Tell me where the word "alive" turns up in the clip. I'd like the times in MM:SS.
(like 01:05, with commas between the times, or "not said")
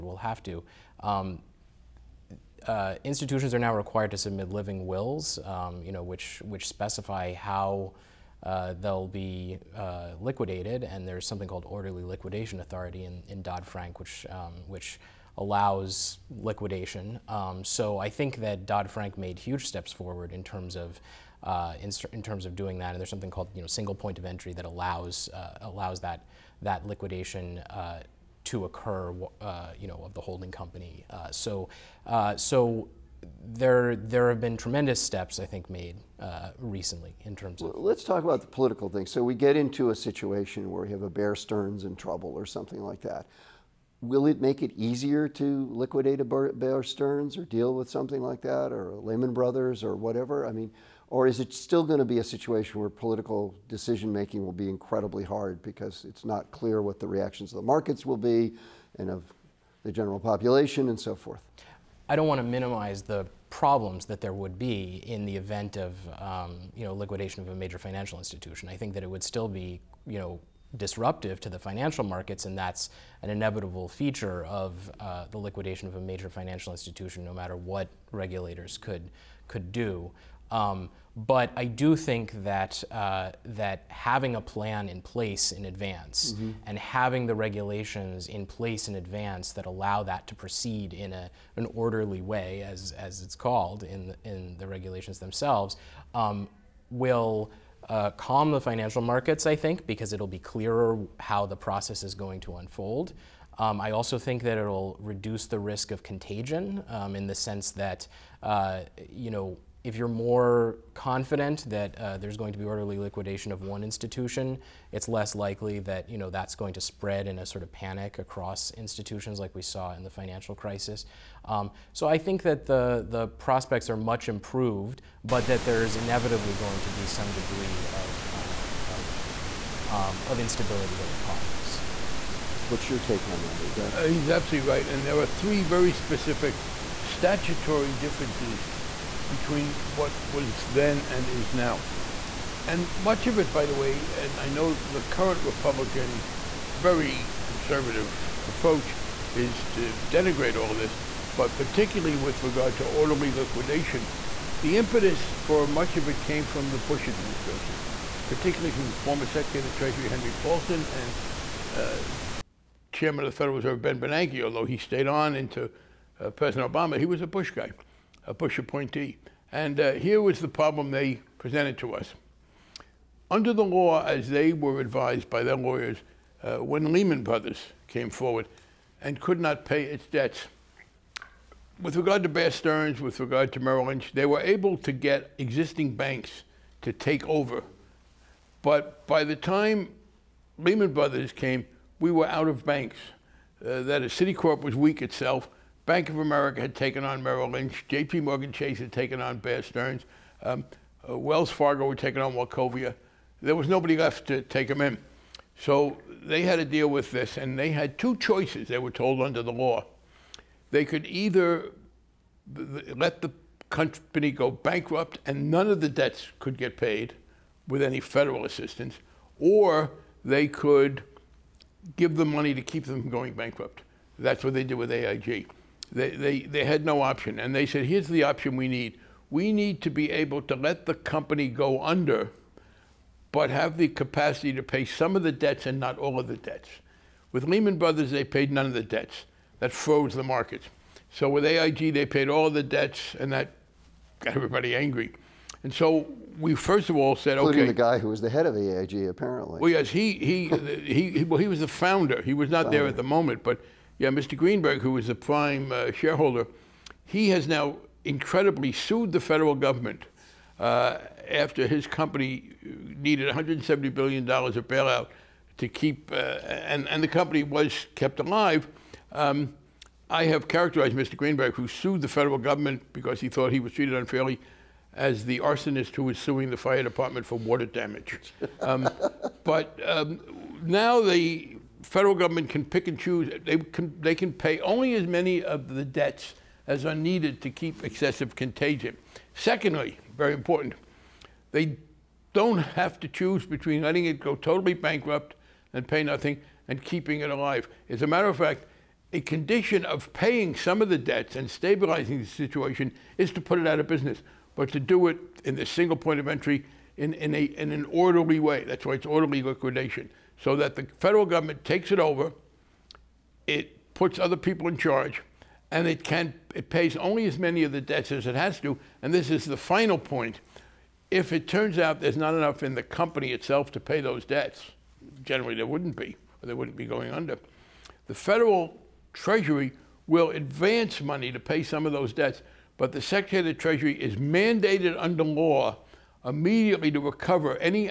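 04:28, 04:57.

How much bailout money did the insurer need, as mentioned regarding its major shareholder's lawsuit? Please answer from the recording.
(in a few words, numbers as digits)
$170 billion.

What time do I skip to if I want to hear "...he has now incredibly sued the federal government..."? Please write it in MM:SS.
04:17.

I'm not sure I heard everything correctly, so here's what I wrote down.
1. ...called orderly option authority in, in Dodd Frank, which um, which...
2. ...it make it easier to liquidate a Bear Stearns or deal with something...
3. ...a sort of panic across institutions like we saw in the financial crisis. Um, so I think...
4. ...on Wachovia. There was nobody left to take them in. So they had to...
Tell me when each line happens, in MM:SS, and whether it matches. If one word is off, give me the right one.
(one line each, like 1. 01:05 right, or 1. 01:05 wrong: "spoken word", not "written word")
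1. 00:11 wrong: "liquidation", not "option"
2. 00:44 right
3. 01:57 right
4. 03:22 right.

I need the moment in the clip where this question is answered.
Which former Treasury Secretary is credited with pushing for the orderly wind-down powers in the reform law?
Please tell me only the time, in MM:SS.
02:40.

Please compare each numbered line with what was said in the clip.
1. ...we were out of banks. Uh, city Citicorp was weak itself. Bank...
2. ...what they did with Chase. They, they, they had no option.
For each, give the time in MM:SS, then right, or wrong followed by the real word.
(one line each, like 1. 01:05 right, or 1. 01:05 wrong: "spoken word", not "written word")
1. 03:11 right
2. 03:44 wrong: "AIG", not "Chase".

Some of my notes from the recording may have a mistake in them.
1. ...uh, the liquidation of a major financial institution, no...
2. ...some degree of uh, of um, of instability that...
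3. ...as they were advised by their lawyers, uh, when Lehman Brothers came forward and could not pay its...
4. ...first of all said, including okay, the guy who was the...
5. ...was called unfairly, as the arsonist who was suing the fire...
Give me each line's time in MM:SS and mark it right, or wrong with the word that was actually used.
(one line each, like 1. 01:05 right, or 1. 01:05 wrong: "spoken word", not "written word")
1. 01:14 right
2. 02:07 right
3. 02:54 right
4. 04:06 right
5. 04:33 wrong: "treated", not "called".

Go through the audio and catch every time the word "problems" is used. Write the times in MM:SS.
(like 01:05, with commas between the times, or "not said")
01:03, 02:50.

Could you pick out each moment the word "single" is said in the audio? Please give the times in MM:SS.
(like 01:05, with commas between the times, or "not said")
00:23, 05:05.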